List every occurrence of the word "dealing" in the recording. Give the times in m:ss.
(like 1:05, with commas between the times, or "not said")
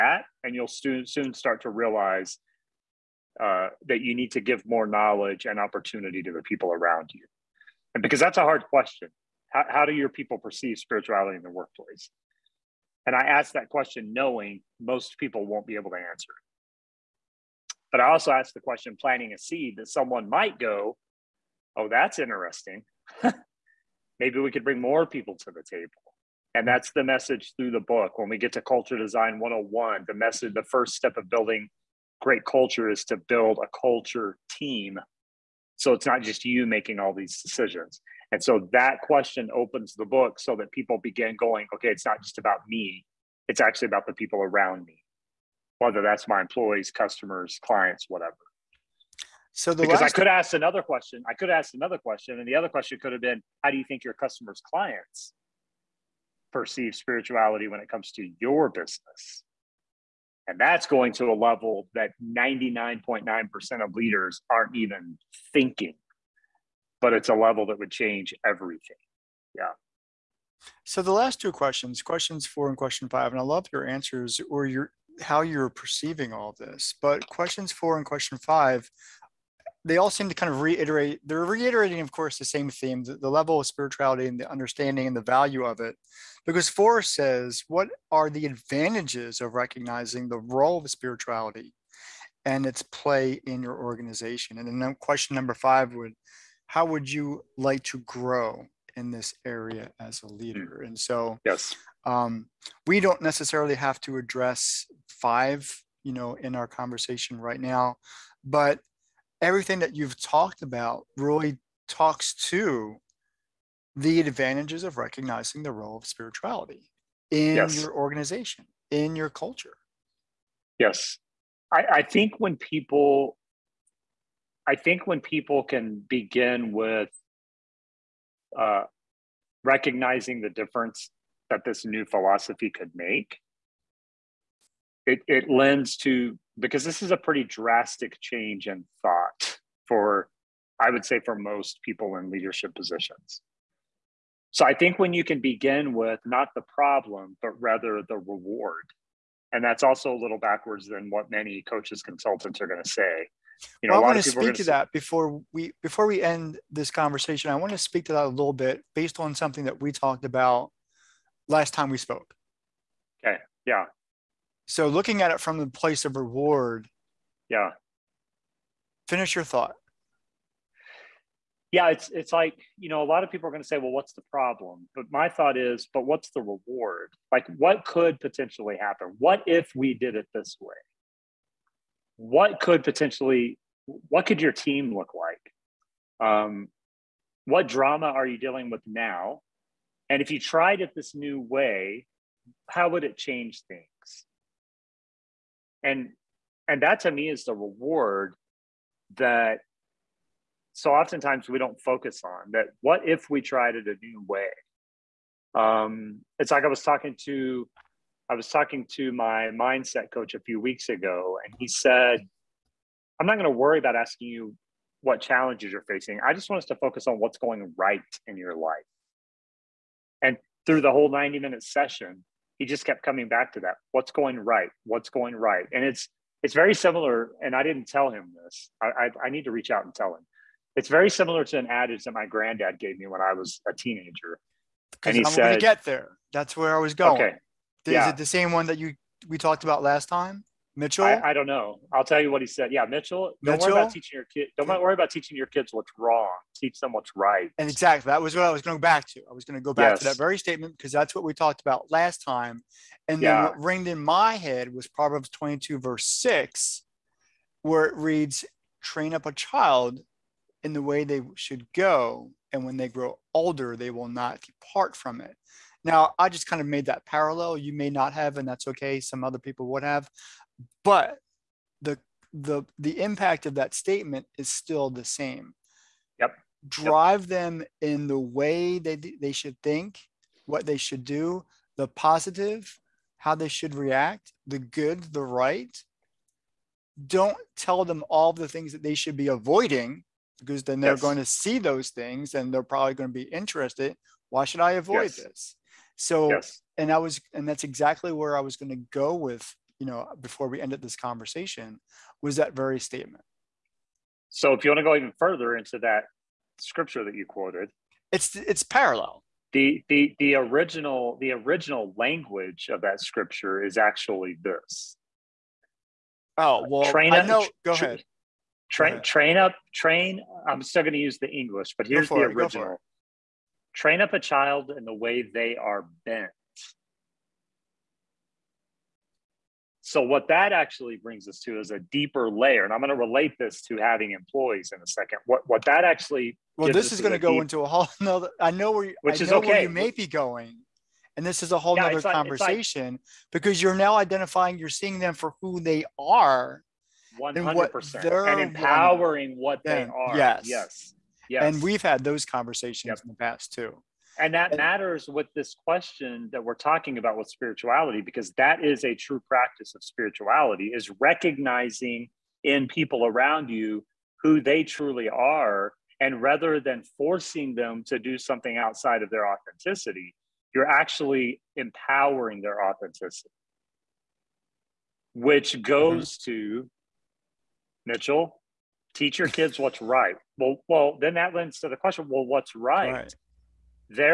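3:08.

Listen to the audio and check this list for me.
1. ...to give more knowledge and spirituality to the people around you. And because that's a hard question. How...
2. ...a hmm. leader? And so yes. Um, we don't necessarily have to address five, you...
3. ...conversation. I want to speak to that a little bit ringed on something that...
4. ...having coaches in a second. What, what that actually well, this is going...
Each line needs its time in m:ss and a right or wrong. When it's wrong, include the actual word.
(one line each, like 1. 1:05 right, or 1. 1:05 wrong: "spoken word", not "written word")
1. 0:04 wrong: "opportunity", not "spirituality"
2. 1:40 right
3. 2:36 wrong: "based", not "ringed"
4. 5:33 wrong: "employees", not "coaches".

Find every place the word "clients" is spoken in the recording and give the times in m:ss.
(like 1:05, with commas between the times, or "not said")
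0:47, 0:54.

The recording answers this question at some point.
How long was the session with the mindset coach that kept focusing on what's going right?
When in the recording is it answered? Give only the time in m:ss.
3:41.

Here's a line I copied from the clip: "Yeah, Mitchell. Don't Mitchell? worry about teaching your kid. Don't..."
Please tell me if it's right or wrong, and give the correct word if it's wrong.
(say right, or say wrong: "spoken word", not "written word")
right.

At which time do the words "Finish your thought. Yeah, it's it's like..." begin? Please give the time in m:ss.
2:49.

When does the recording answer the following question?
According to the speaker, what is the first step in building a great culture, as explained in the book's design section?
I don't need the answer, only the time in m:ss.
0:33.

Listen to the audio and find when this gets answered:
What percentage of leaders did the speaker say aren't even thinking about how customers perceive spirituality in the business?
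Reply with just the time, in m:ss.
1:02.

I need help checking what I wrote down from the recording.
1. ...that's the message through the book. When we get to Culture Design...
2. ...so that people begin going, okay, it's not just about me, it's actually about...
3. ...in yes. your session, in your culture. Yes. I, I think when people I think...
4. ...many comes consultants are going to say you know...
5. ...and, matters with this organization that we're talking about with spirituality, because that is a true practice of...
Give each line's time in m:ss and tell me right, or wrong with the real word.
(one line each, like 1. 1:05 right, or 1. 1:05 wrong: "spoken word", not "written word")
1. 0:26 right
2. 0:40 right
3. 1:57 wrong: "organization", not "session"
4. 2:31 wrong: "coaches", not "comes"
5. 5:54 wrong: "question", not "organization".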